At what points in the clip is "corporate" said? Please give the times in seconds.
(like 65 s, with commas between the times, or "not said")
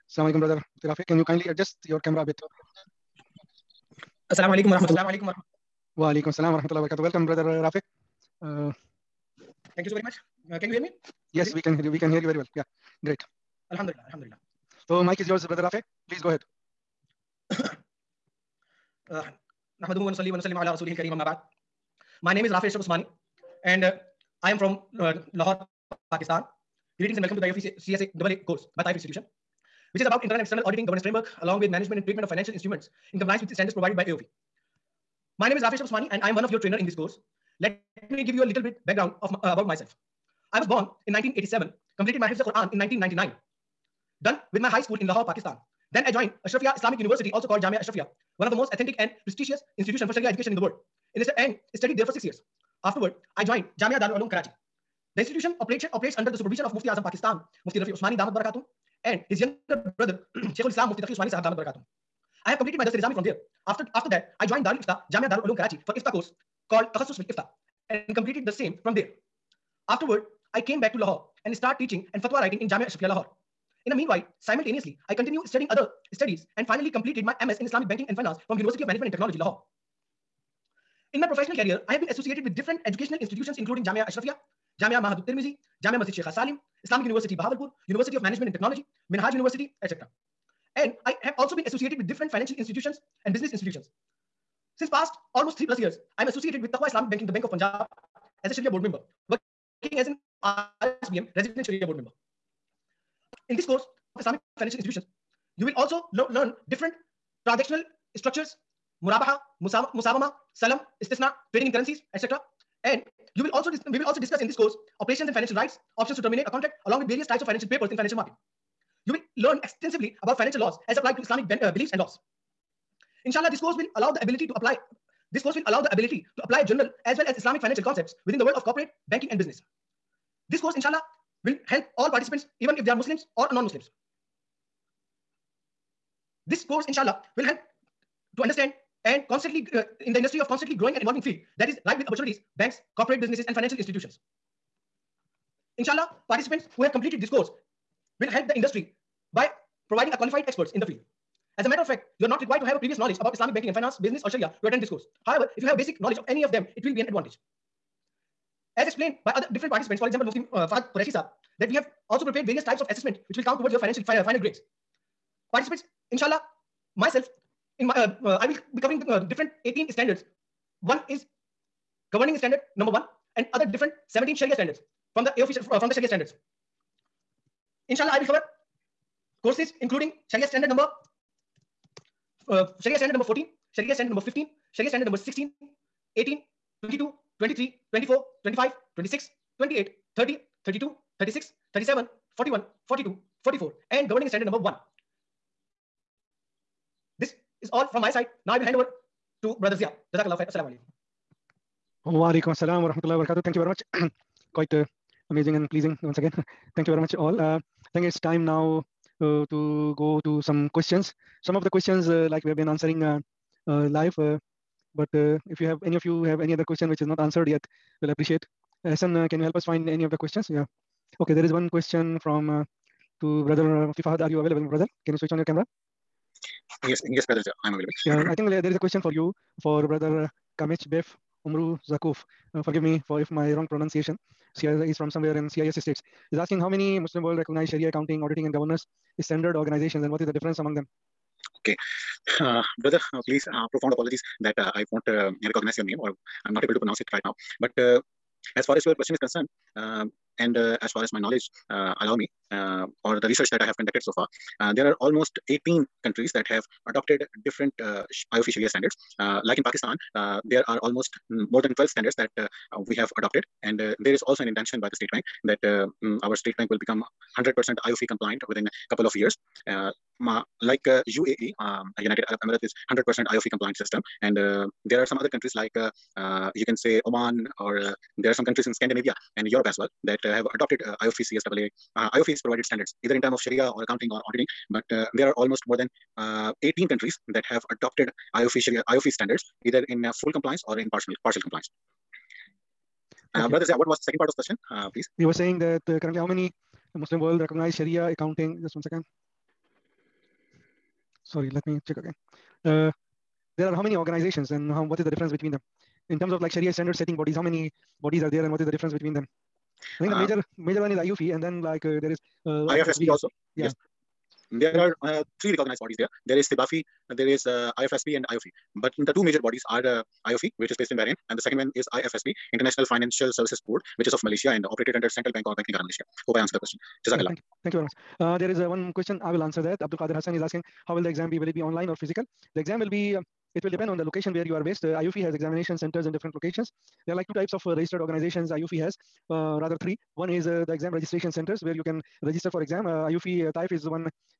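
128 s, 142 s.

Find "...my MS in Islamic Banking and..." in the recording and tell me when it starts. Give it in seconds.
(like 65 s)
77 s.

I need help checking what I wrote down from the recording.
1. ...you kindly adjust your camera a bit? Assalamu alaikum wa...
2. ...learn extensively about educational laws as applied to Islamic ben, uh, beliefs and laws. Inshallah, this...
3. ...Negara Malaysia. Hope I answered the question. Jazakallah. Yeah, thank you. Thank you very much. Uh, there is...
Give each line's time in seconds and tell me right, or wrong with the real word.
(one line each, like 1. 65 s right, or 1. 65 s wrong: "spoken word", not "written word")
1. 1 s right
2. 119 s wrong: "financial", not "educational"
3. 325 s right.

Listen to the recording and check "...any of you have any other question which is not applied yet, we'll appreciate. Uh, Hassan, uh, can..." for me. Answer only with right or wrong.
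wrong.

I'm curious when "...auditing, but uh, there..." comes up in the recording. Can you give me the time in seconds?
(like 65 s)
284 s.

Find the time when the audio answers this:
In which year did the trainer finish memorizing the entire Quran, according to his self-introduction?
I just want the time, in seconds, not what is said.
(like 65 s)
42 s.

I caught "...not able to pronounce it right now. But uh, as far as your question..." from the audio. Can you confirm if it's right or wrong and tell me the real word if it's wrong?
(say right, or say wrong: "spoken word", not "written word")
right.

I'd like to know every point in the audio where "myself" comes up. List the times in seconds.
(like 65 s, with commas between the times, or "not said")
39 s, 166 s.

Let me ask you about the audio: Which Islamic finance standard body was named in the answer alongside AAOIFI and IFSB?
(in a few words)
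CIBAFI.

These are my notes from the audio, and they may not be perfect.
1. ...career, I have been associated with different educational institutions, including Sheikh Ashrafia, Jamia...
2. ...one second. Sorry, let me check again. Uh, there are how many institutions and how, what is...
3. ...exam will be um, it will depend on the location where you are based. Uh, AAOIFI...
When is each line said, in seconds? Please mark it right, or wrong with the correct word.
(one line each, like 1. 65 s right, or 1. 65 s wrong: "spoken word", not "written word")
1. 81 s wrong: "Jamia", not "Sheikh"
2. 298 s wrong: "organizations", not "institutions"
3. 332 s right.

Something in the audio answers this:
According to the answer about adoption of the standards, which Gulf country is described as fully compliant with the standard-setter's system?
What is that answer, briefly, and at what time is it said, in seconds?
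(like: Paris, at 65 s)
UAE, at 271 s.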